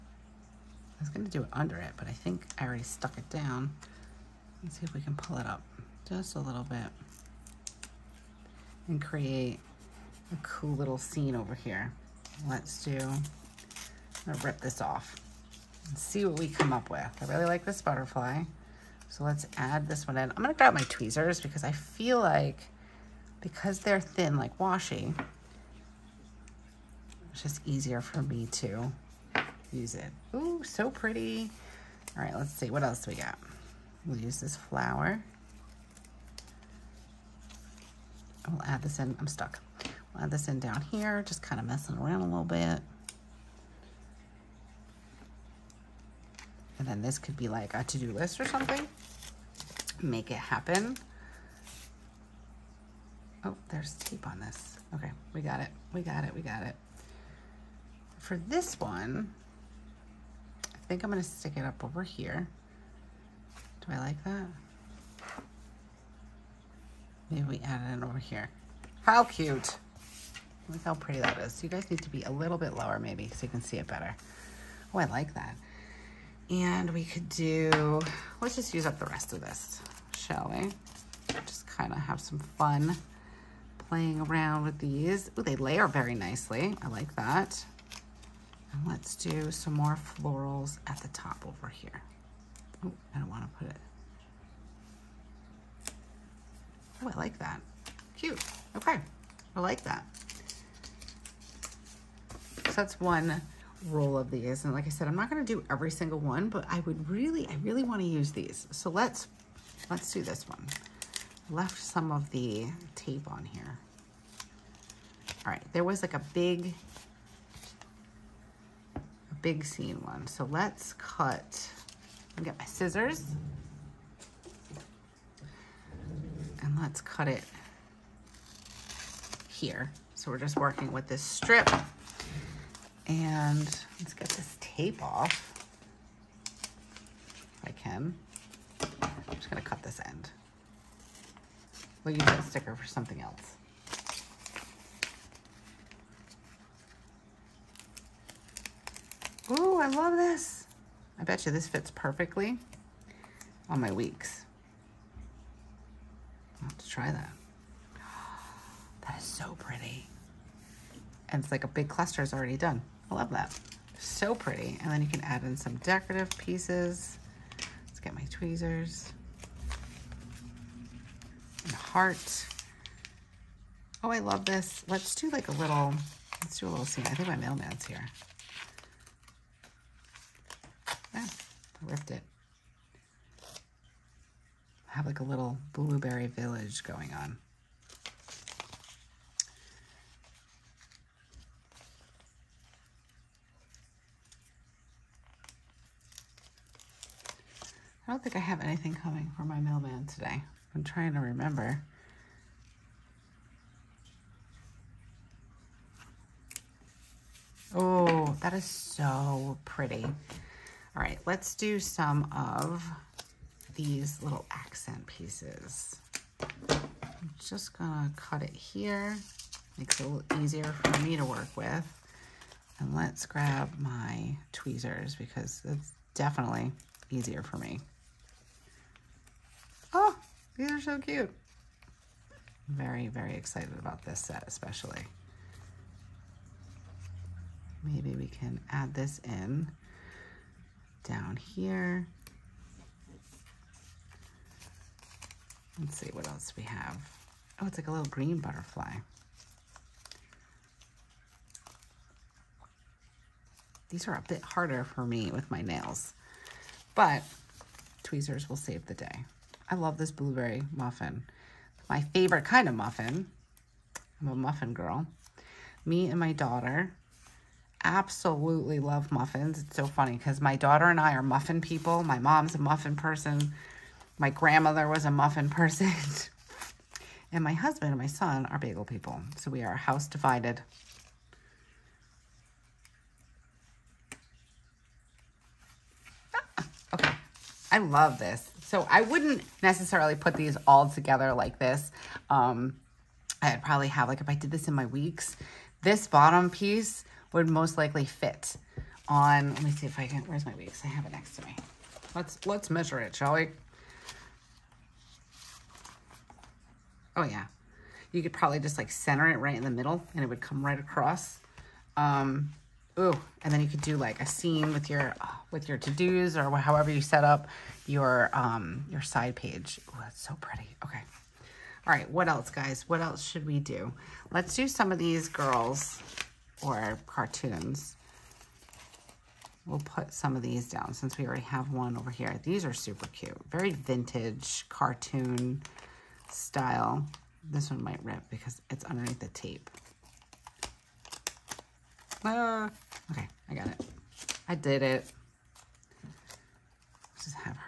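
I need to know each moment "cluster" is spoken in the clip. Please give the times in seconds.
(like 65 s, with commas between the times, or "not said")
161 s.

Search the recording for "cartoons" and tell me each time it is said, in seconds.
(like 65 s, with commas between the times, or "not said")
327 s, 334 s.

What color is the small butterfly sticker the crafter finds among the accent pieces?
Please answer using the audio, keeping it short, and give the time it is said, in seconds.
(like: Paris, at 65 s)
Green, at 248 s.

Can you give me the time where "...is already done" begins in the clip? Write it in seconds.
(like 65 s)
162 s.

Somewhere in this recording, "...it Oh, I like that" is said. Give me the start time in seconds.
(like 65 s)
93 s.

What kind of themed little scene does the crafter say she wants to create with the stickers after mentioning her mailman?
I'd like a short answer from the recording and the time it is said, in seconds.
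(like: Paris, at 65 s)
Blueberry village, at 185 s.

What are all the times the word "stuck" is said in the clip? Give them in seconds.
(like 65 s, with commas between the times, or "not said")
2 s, 39 s.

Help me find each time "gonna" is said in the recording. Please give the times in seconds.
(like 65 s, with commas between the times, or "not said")
14 s, 20 s, 139 s, 217 s.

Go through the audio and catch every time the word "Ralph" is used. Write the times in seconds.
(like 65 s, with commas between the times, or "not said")
not said.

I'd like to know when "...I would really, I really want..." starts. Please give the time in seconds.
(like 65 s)
106 s.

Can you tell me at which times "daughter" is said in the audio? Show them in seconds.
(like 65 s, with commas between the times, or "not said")
266 s, 270 s.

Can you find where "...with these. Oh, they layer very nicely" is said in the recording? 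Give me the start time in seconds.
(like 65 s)
84 s.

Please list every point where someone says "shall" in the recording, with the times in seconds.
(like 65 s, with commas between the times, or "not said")
80 s, 303 s.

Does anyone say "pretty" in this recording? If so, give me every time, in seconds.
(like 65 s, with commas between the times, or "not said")
30 s, 70 s, 159 s, 164 s, 209 s, 320 s.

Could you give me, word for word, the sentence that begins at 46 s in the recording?
And then this could be like a to-do list or something.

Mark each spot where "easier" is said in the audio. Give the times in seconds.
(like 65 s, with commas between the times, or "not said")
27 s, 220 s, 227 s.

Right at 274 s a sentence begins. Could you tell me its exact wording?
My grandmother was a muffin person.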